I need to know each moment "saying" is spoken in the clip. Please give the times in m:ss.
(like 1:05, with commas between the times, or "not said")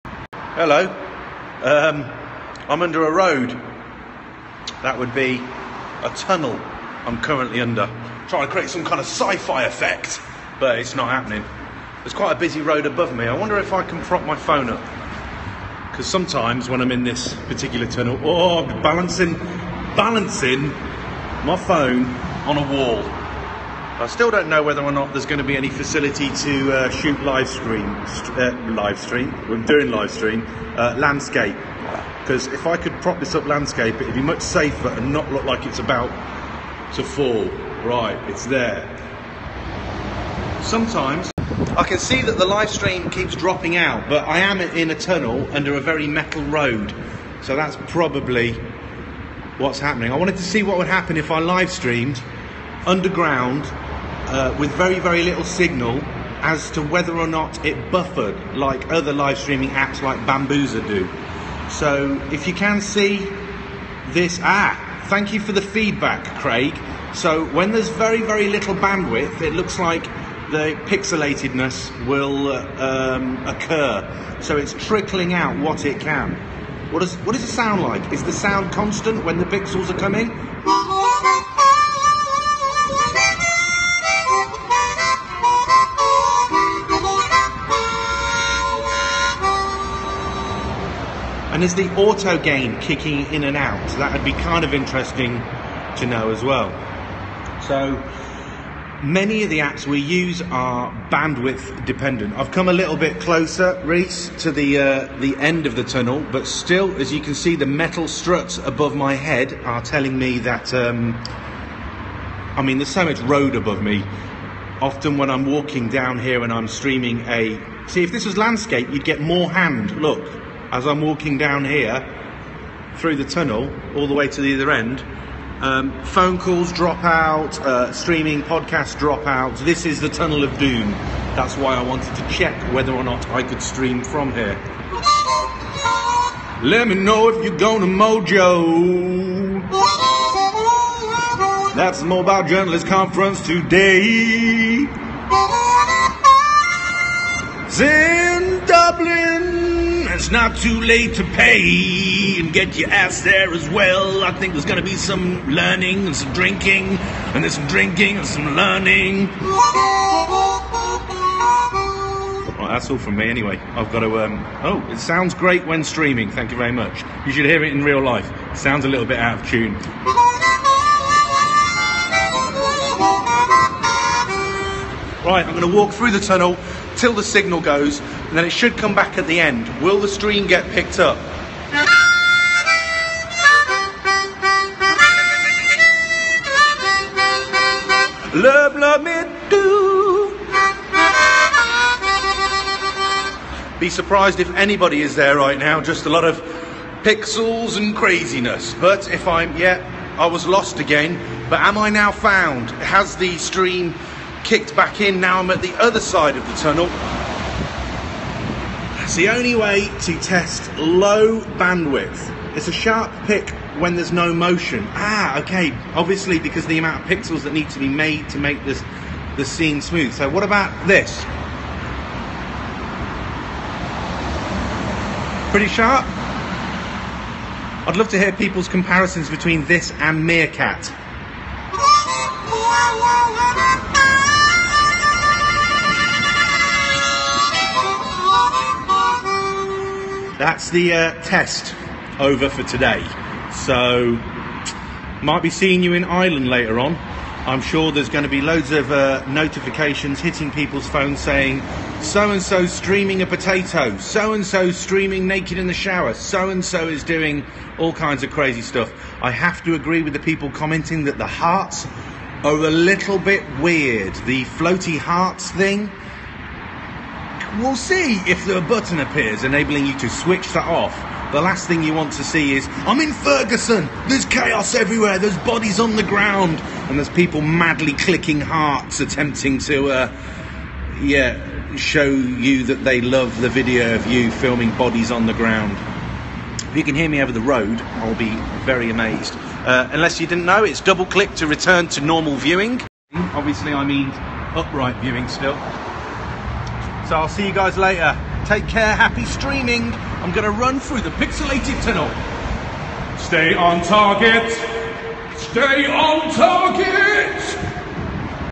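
4:11.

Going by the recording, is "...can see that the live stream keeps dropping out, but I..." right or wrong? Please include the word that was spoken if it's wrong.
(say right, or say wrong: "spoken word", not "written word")
right.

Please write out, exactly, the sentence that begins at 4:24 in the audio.
The floaty hearts thing We'll see if the button appears enabling you to switch that off.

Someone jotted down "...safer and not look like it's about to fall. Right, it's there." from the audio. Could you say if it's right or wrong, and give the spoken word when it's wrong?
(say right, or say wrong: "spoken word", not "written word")
right.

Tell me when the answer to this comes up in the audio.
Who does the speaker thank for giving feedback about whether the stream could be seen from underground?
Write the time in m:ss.
1:06.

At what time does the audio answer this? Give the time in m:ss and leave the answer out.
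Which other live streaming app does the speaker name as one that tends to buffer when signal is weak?
1:00.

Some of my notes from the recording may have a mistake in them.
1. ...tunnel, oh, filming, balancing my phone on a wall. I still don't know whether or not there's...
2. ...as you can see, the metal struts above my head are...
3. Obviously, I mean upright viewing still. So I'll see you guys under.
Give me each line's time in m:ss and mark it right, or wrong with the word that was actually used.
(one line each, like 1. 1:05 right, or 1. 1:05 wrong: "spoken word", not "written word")
1. 0:17 wrong: "balancing", not "filming"
2. 1:46 right
3. 4:53 wrong: "later", not "under".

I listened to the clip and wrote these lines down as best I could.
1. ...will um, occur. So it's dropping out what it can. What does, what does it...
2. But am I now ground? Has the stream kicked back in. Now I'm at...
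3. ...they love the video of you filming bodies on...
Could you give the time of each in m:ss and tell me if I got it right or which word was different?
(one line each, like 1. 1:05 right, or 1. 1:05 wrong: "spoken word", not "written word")
1. 1:12 wrong: "trickling", not "dropping"
2. 3:21 wrong: "found", not "ground"
3. 4:42 right.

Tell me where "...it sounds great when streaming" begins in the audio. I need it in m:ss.
2:44.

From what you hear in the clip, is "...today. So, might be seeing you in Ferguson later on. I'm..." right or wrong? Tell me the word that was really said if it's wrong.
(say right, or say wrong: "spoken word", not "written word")
wrong: "Ireland", not "Ferguson".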